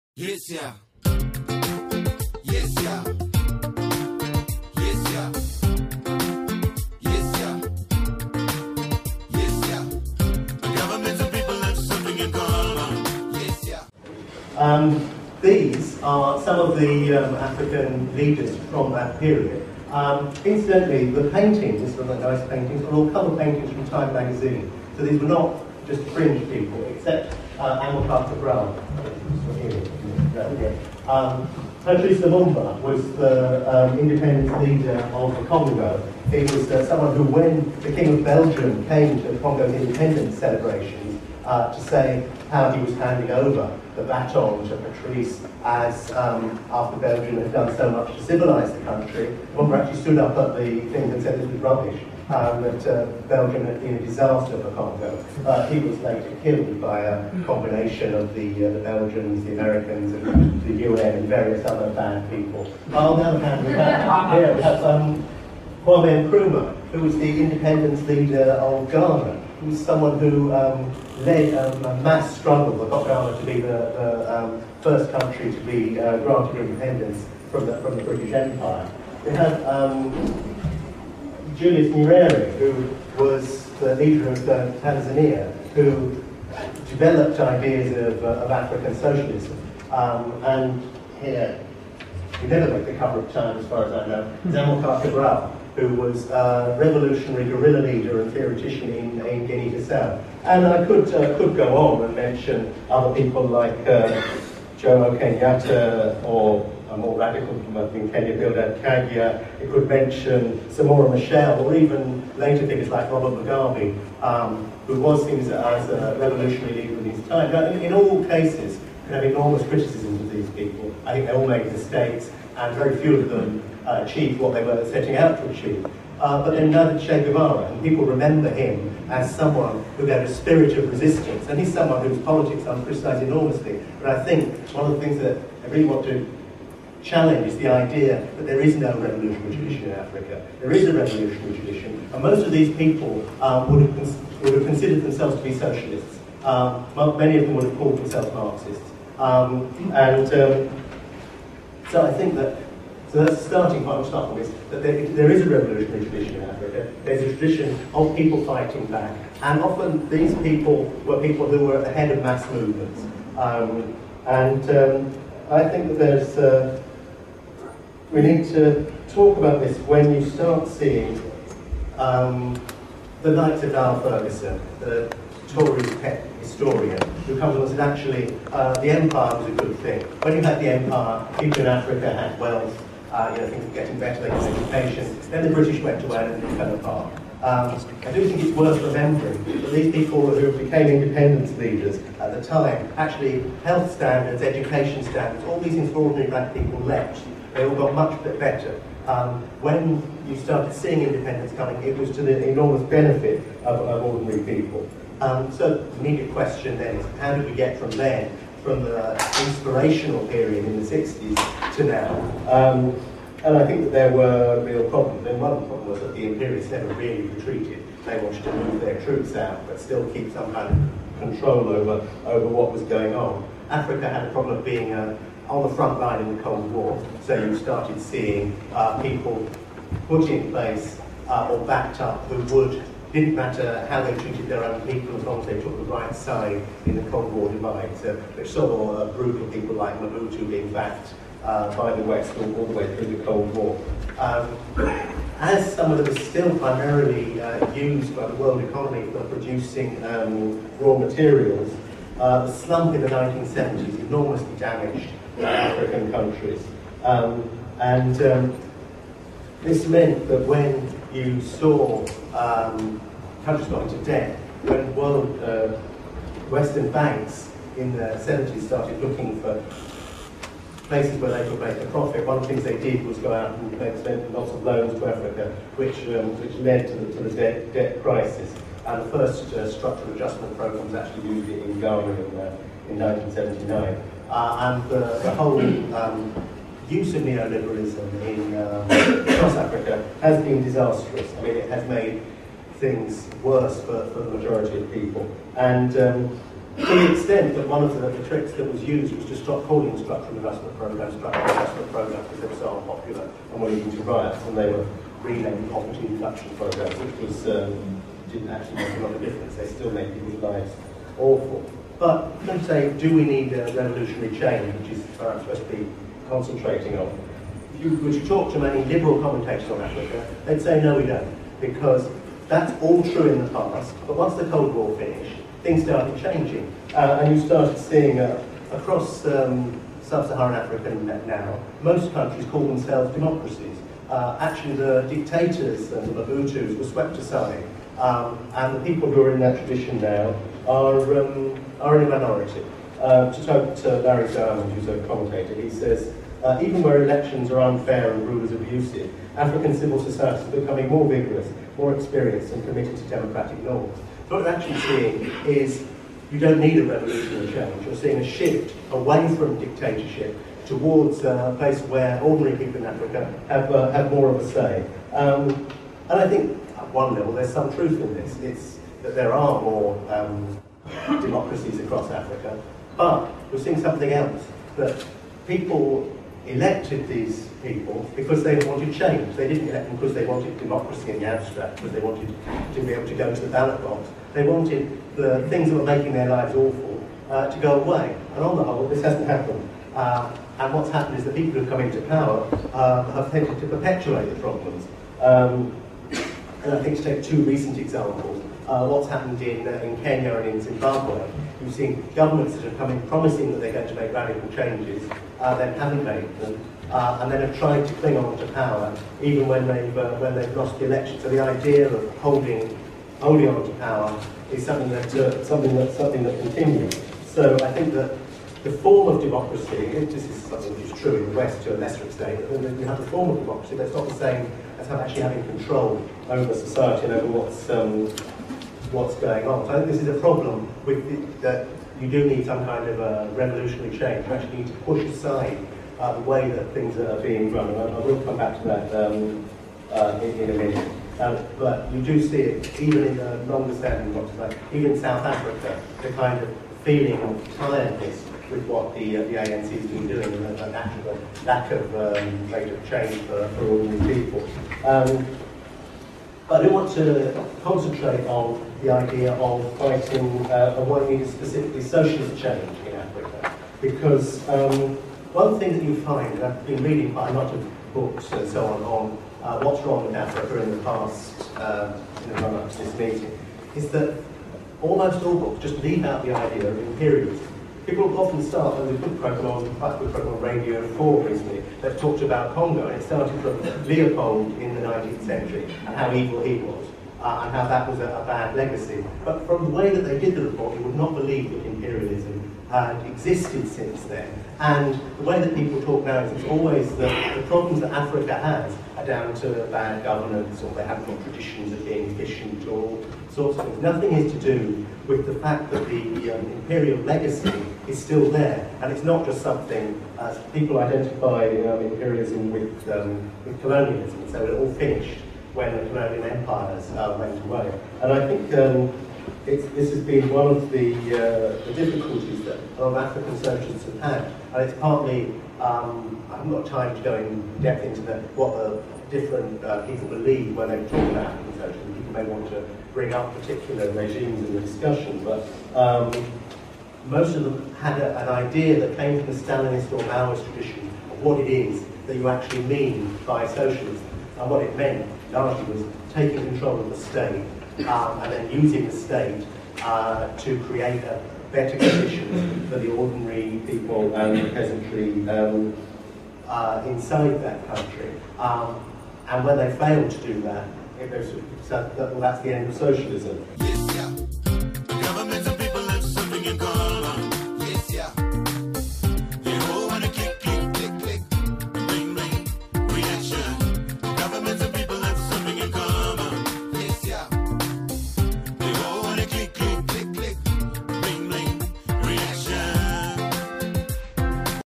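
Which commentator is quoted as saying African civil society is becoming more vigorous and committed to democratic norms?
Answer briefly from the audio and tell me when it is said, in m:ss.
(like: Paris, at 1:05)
Larry Diamond, at 5:44.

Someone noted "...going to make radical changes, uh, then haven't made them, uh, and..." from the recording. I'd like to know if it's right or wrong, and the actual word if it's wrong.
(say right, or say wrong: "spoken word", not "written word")
right.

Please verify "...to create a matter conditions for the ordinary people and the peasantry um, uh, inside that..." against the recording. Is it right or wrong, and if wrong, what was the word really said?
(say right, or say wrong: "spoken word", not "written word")
wrong: "better", not "matter".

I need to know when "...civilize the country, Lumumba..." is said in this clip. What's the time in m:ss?
0:48.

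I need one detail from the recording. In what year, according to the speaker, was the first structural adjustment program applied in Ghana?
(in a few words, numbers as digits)
1979.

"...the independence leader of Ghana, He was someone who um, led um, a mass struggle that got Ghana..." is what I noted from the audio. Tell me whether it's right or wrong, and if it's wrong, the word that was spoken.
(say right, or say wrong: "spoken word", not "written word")
right.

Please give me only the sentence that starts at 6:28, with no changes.
And on the whole, this hasn't happened.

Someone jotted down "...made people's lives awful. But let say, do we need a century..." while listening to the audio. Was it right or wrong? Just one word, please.
wrong.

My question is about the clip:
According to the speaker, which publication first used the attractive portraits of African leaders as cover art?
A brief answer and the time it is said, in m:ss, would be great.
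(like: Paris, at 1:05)
Time magazine, at 0:23.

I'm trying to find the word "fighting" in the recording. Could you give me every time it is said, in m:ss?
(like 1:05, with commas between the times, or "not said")
2:38, 7:39.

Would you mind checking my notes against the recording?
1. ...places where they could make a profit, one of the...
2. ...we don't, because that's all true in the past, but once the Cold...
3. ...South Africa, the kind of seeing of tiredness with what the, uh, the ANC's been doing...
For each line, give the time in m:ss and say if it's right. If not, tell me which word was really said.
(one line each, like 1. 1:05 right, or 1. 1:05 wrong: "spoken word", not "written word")
1. 4:30 right
2. 5:20 right
3. 7:24 wrong: "feeling", not "seeing".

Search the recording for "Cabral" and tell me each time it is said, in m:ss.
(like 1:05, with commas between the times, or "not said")
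0:28, 1:35.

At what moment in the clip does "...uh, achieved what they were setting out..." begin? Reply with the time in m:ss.
2:03.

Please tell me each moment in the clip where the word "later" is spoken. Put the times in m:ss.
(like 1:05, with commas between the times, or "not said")
0:55, 1:52.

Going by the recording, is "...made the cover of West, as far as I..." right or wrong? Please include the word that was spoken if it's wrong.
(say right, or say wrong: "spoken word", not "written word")
wrong: "Time", not "West".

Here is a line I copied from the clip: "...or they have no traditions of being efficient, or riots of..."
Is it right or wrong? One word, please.
wrong.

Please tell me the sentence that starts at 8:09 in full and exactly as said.
But from the way that they did the report, you would not believe that imperialism had existed since then.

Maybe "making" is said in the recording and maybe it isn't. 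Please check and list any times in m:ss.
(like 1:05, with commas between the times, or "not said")
6:25.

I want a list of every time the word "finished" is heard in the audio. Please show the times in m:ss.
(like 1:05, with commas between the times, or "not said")
5:24, 8:34.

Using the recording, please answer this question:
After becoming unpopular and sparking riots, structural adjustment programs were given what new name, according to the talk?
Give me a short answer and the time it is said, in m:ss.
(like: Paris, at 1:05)
poverty reduction programs, at 5:05.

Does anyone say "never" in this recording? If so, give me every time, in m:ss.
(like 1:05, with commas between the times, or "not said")
1:32, 3:36.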